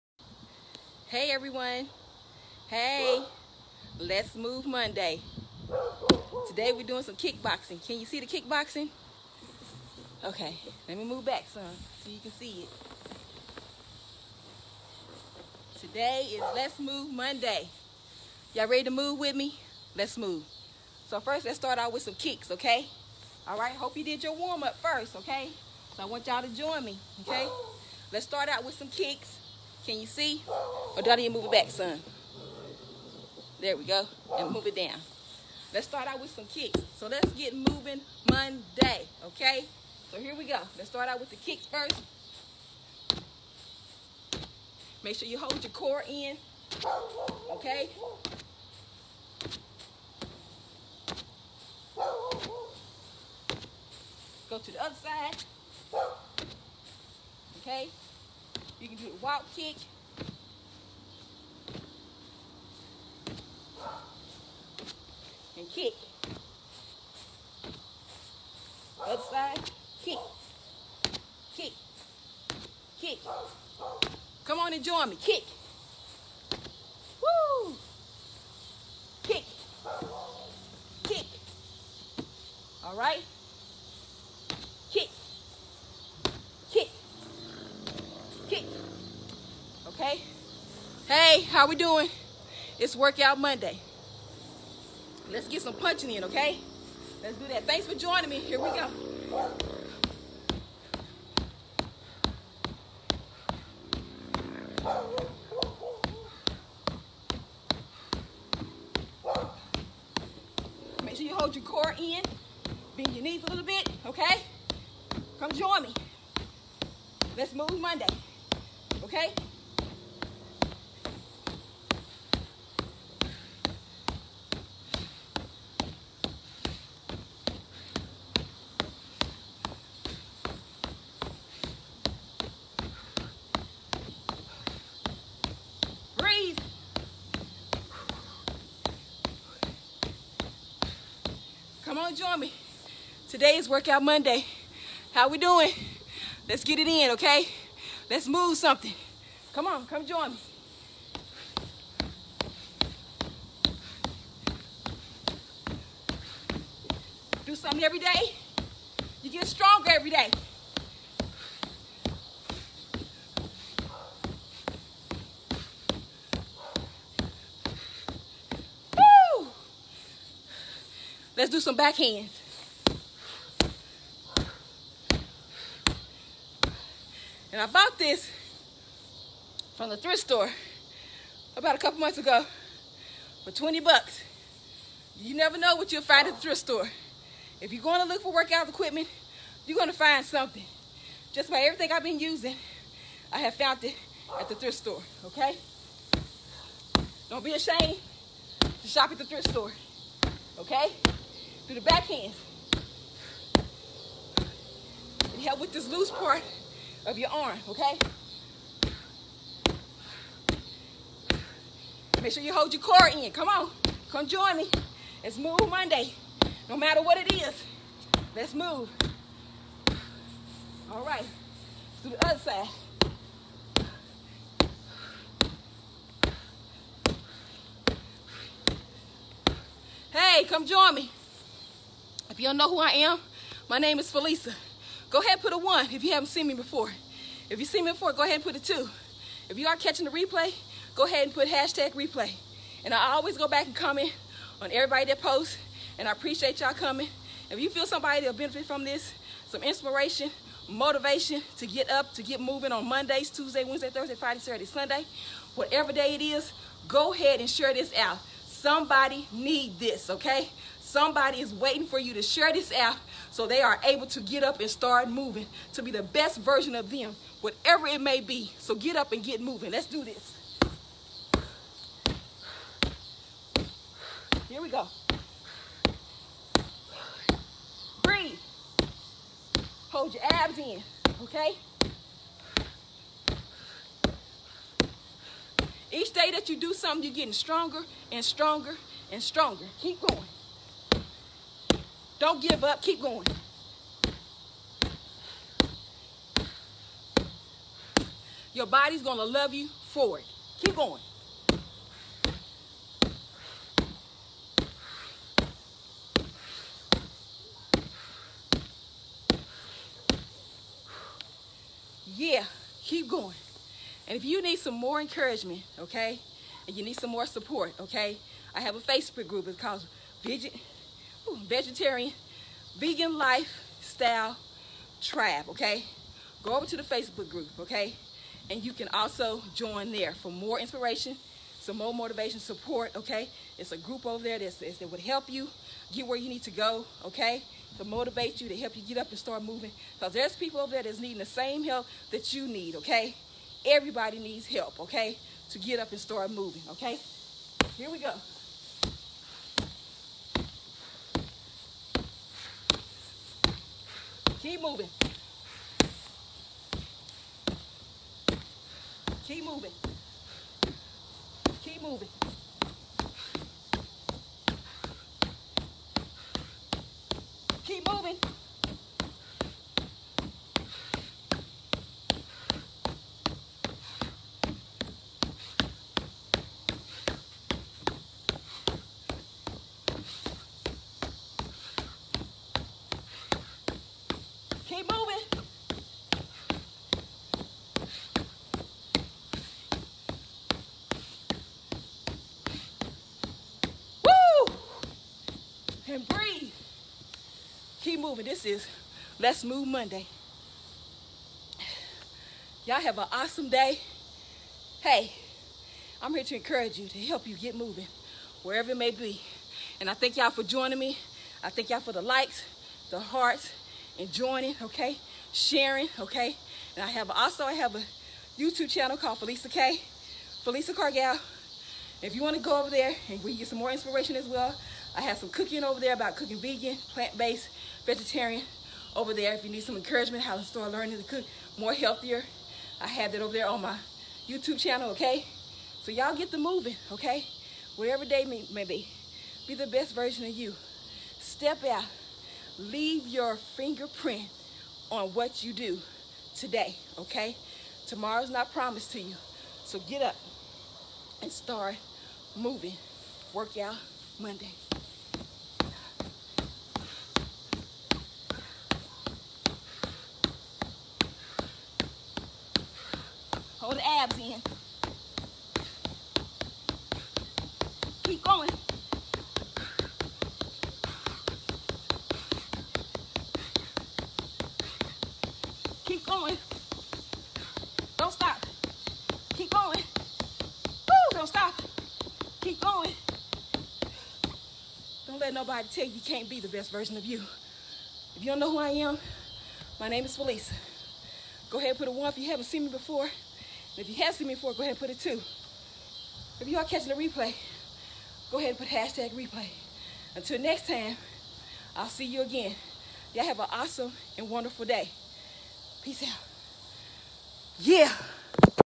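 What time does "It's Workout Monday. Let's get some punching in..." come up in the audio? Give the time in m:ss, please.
1:32.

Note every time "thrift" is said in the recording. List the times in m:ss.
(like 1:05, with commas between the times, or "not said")
2:59, 3:06, 3:14, 3:19.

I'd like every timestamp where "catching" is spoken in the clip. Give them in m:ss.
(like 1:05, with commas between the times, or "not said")
3:59, 8:16.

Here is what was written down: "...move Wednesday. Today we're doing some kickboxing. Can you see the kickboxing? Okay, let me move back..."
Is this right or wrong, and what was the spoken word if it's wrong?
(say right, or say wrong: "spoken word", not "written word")
wrong: "Monday", not "Wednesday".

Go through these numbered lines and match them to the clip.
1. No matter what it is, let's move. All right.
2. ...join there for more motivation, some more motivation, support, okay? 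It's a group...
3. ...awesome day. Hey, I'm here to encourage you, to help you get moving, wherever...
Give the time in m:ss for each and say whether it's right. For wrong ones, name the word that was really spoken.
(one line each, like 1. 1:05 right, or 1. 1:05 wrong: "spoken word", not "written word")
1. 3:36 right
2. 5:29 wrong: "inspiration", not "motivation"
3. 6:43 right.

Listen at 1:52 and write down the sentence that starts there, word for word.
Bend your knees a little bit, okay?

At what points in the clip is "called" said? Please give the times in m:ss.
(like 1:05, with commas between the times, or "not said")
5:19, 6:58.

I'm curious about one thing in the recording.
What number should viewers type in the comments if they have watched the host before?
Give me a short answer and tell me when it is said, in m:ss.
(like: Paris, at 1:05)
2, at 3:58.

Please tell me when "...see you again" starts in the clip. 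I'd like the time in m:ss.
8:21.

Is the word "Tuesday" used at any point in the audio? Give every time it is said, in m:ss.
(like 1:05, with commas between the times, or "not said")
4:13.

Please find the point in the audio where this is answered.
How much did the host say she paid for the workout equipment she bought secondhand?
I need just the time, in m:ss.
3:03.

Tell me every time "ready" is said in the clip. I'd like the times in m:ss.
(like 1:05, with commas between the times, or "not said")
0:18.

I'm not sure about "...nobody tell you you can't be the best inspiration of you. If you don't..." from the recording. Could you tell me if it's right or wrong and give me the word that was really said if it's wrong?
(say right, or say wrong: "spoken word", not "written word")
wrong: "version", not "inspiration".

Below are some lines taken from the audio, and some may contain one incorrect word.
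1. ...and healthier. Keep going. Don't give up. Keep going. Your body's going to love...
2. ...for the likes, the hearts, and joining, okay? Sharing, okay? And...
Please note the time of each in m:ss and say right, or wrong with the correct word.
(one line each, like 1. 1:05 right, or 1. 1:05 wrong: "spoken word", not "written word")
1. 4:49 wrong: "stronger", not "healthier"
2. 6:51 right.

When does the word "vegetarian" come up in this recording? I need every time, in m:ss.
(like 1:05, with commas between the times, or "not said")
5:21, 7:07.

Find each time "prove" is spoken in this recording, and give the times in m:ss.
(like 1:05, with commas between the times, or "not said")
not said.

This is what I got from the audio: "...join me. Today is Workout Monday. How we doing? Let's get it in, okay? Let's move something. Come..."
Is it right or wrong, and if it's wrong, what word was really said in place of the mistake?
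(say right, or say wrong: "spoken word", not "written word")
right.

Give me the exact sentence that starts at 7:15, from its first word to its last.
So y'all get the moving, okay?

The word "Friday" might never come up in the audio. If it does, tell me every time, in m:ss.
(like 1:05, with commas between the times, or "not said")
4:14.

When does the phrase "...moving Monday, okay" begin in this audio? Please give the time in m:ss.
0:37.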